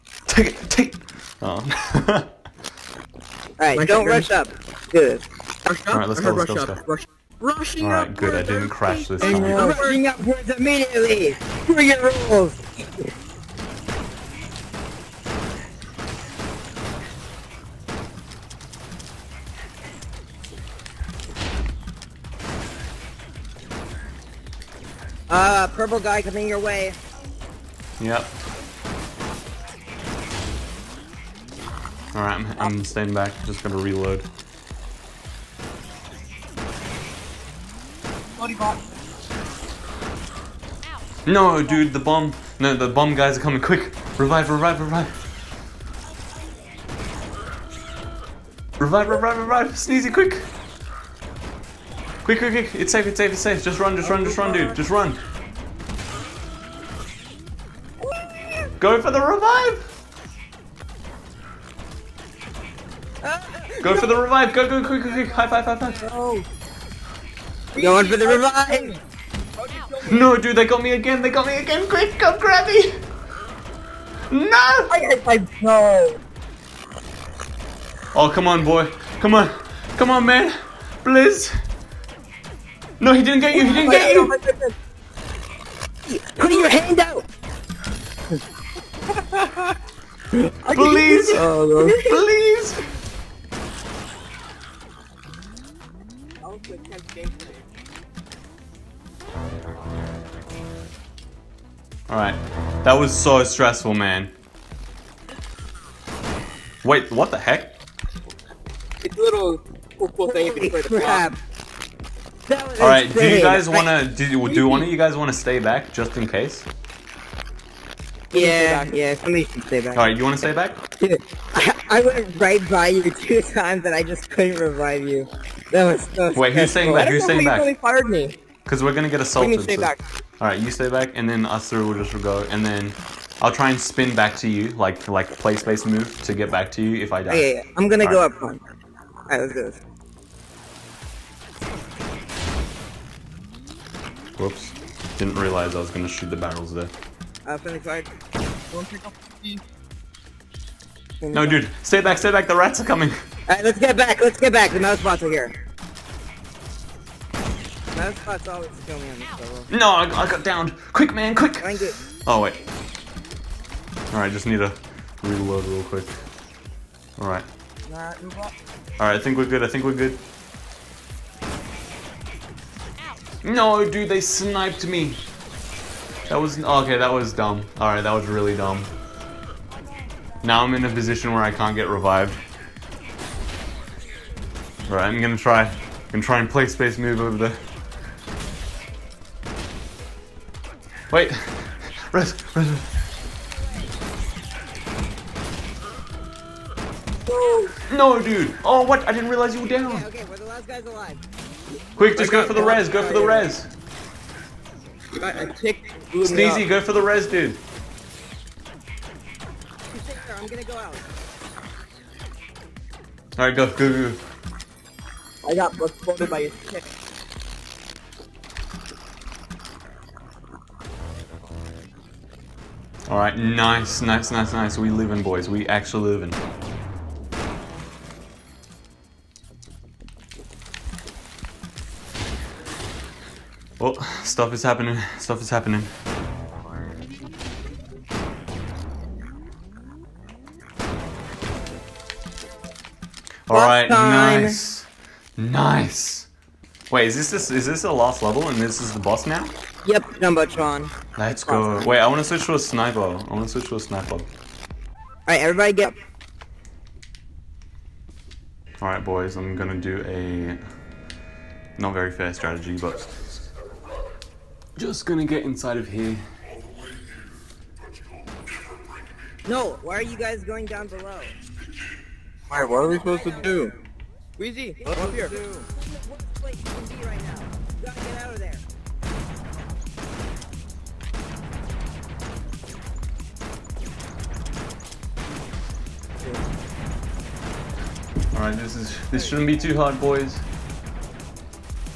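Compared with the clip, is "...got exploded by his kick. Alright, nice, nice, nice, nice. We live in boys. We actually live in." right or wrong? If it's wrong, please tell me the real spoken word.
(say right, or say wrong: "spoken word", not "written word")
right.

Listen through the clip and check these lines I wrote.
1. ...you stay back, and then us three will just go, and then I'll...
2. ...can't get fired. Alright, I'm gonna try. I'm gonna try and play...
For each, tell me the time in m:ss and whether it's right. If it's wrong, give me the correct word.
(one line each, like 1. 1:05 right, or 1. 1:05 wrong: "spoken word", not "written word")
1. 2:10 right
2. 3:01 wrong: "revived", not "fired".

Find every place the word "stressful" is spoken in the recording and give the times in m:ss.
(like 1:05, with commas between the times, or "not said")
1:43.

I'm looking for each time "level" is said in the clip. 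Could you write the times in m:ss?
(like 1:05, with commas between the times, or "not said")
2:39, 4:08.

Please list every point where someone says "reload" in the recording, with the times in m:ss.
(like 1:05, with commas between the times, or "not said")
0:33, 2:45.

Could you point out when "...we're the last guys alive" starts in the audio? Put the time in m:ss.
3:20.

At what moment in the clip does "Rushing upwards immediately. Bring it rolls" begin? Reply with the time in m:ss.
0:09.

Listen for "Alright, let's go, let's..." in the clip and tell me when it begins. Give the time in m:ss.
0:05.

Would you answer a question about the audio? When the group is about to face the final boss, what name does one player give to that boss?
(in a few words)
Jumbotron.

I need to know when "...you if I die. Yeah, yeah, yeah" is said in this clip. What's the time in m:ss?
2:16.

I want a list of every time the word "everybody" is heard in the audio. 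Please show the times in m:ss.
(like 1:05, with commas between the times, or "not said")
4:15.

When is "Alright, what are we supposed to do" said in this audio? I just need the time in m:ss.
4:32.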